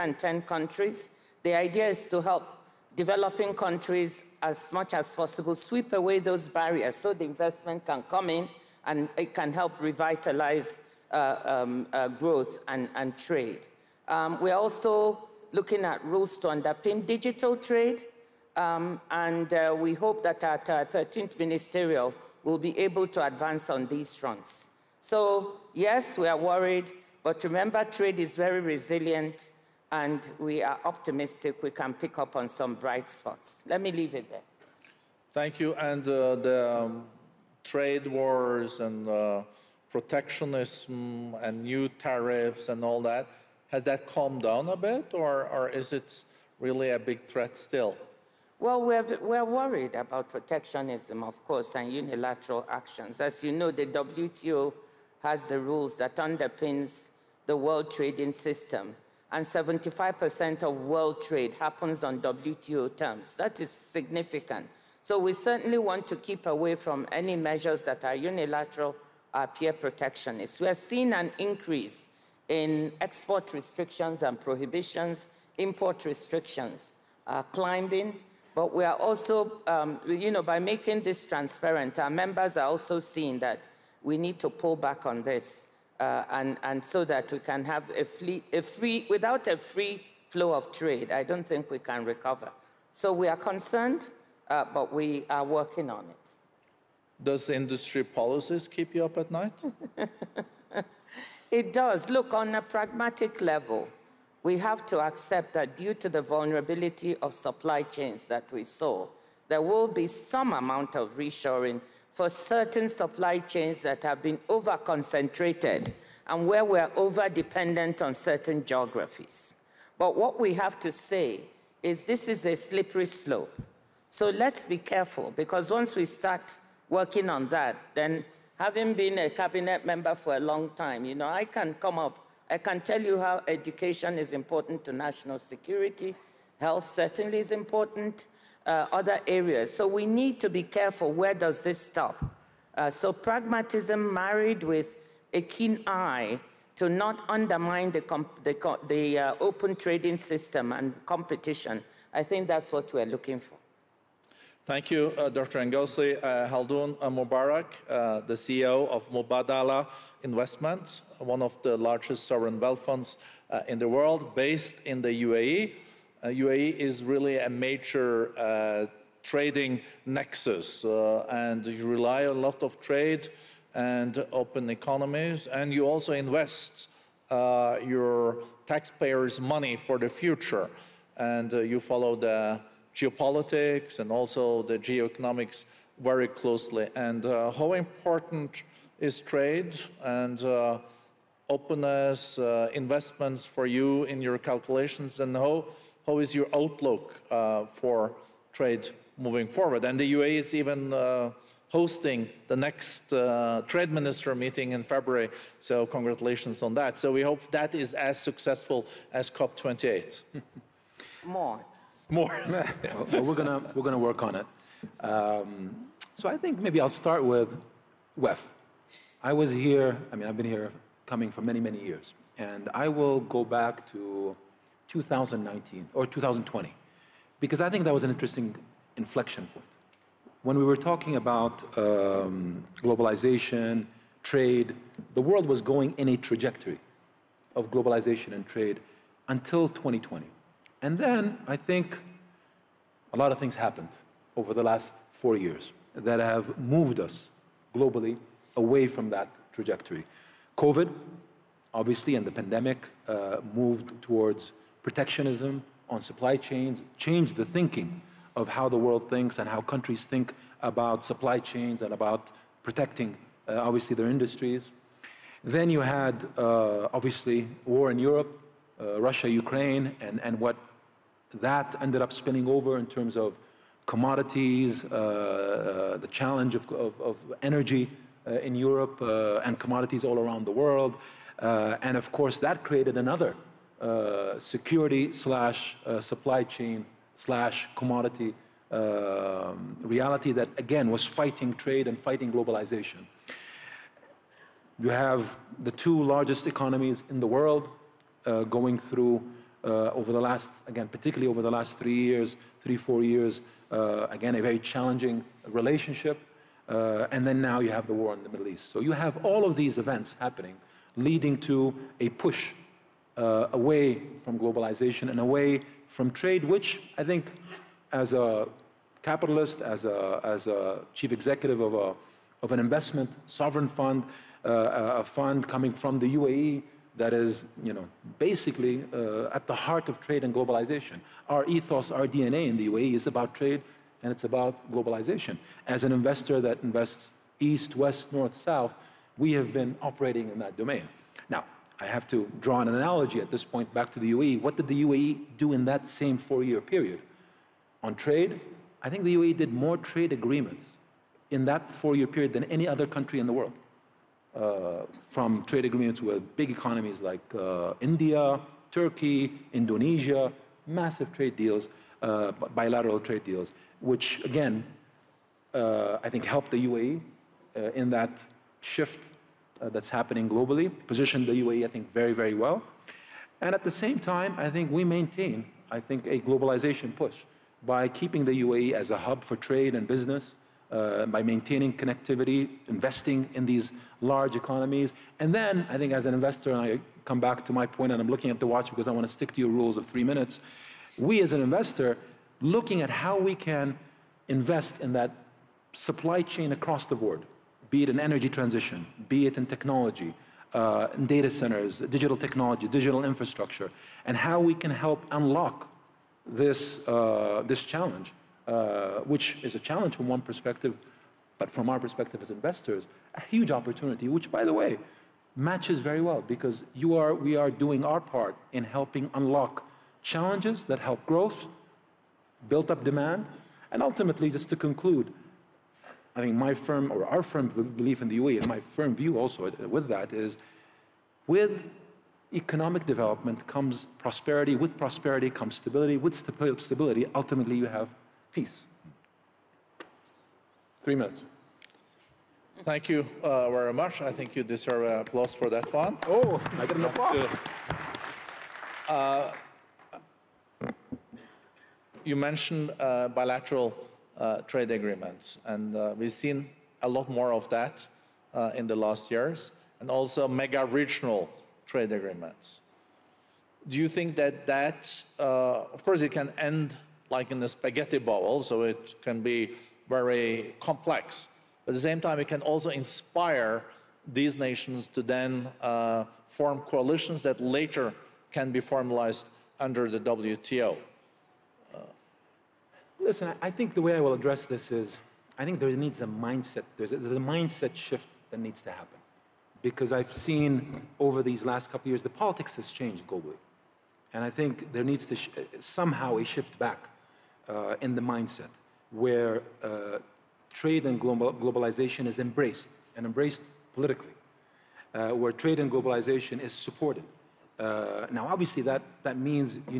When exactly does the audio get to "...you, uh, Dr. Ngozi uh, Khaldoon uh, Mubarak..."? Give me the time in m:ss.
2:34.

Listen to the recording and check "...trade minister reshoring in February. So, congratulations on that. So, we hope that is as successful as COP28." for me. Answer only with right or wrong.
wrong.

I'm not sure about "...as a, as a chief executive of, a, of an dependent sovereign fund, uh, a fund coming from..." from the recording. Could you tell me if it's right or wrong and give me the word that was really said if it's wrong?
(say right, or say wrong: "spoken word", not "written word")
wrong: "investment", not "dependent".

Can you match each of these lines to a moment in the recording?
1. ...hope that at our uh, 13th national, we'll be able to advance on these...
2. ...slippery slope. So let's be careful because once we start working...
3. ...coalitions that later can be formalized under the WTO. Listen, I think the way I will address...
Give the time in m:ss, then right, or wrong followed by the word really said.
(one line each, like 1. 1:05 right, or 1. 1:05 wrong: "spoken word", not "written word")
1. 0:19 wrong: "ministerial", not "national"
2. 2:02 right
3. 7:56 right.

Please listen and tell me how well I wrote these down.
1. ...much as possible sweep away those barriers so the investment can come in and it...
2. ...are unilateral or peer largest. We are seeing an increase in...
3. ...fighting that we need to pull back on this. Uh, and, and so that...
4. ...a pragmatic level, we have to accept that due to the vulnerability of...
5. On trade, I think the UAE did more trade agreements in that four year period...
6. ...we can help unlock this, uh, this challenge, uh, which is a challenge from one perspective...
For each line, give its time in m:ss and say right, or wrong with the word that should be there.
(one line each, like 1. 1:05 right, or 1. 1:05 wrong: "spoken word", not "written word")
1. 0:04 right
2. 1:08 wrong: "protectionist", not "largest"
3. 1:22 wrong: "seeing", not "fighting"
4. 1:42 right
5. 5:47 right
6. 6:44 right.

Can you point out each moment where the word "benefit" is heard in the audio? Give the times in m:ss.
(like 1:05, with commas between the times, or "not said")
not said.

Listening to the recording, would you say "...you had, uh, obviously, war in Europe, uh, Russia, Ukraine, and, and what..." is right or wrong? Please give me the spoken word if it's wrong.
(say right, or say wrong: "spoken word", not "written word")
right.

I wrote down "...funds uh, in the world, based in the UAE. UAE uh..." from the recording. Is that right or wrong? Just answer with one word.
right.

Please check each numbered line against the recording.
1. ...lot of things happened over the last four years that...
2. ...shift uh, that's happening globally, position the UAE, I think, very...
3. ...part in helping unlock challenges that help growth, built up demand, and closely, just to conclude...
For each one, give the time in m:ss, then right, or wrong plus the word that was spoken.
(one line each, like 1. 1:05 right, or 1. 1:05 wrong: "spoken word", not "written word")
1. 4:03 right
2. 6:08 right
3. 6:58 wrong: "ultimately", not "closely".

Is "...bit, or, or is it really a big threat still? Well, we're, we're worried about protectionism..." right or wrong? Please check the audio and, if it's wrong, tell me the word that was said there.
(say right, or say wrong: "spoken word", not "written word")
right.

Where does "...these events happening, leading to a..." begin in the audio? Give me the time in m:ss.
5:09.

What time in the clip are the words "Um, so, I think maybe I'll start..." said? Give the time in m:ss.
3:35.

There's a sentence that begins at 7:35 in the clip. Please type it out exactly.
And uh, we've seen a lot more of that uh, in the last years, and also mega regional trade agreements.